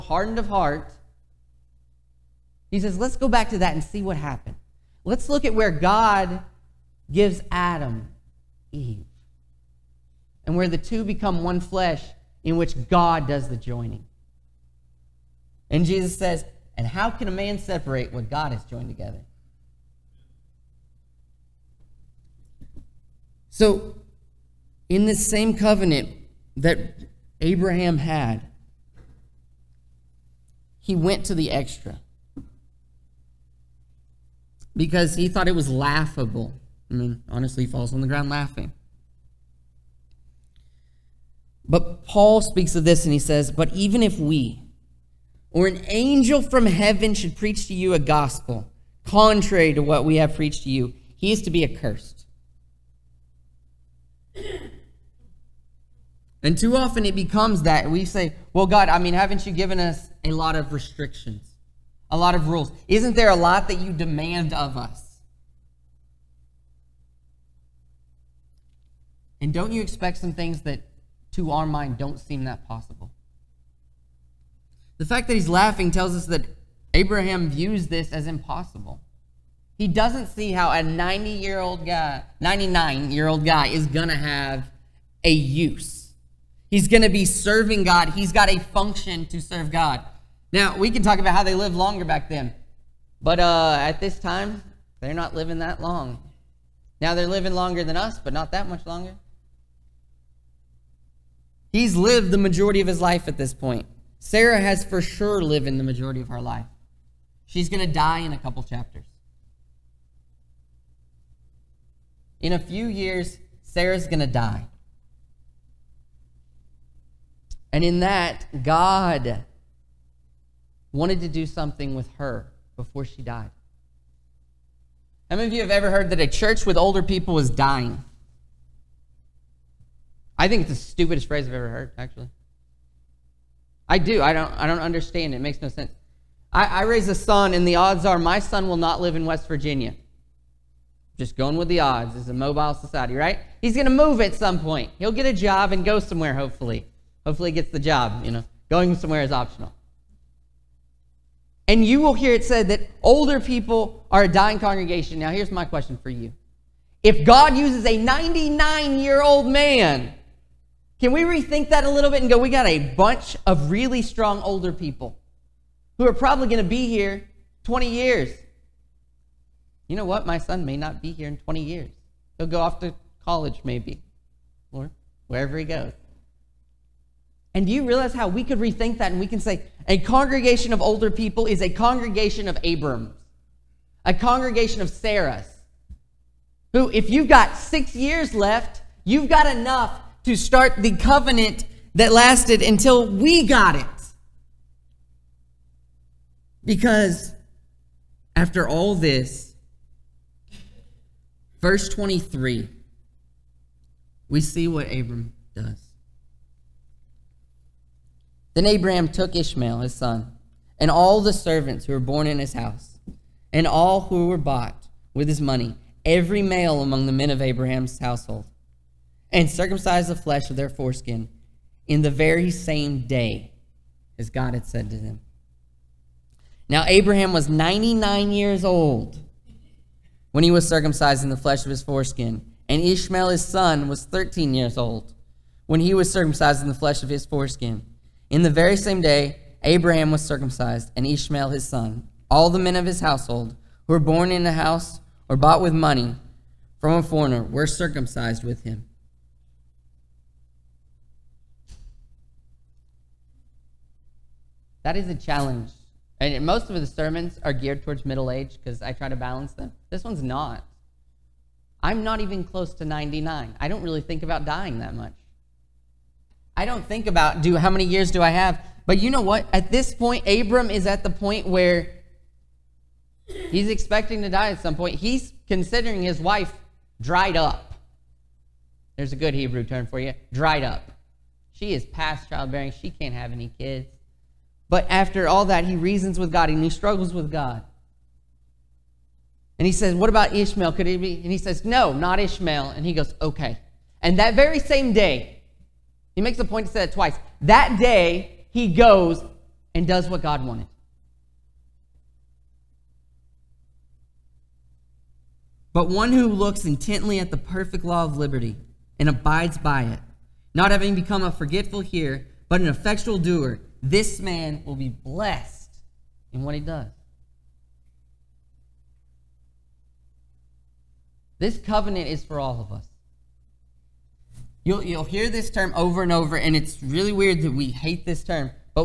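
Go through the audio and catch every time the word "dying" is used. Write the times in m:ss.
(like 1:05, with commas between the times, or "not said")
2:07, 2:34, 4:24.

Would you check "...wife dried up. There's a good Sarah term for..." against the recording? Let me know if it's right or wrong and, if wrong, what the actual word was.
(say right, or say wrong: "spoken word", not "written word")
wrong: "Hebrew", not "Sarah".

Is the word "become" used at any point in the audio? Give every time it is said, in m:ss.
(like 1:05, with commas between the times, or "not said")
0:11, 0:57, 5:10.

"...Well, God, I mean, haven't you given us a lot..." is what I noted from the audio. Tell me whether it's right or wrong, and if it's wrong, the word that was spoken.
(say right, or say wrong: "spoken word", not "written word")
right.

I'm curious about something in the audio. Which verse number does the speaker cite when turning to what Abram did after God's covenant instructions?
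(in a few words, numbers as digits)
23.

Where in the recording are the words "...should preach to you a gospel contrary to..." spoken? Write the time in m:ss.
0:47.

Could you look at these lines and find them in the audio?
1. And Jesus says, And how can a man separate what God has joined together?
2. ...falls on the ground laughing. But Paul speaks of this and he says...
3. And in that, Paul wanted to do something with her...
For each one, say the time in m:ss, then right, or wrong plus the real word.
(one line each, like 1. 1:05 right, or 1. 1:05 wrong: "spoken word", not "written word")
1. 0:15 right
2. 0:37 right
3. 1:57 wrong: "God", not "Paul".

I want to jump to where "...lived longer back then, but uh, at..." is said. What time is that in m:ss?
1:31.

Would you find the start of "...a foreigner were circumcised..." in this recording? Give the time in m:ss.
4:06.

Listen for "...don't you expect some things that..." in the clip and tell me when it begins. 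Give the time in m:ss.
1:09.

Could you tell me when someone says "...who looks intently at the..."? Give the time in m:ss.
5:06.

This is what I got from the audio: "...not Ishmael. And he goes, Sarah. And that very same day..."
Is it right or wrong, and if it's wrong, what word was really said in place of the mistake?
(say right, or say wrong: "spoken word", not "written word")
wrong: "Okay", not "Sarah".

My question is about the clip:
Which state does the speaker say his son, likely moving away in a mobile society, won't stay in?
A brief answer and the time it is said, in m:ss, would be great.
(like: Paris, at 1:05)
West Virginia, at 2:19.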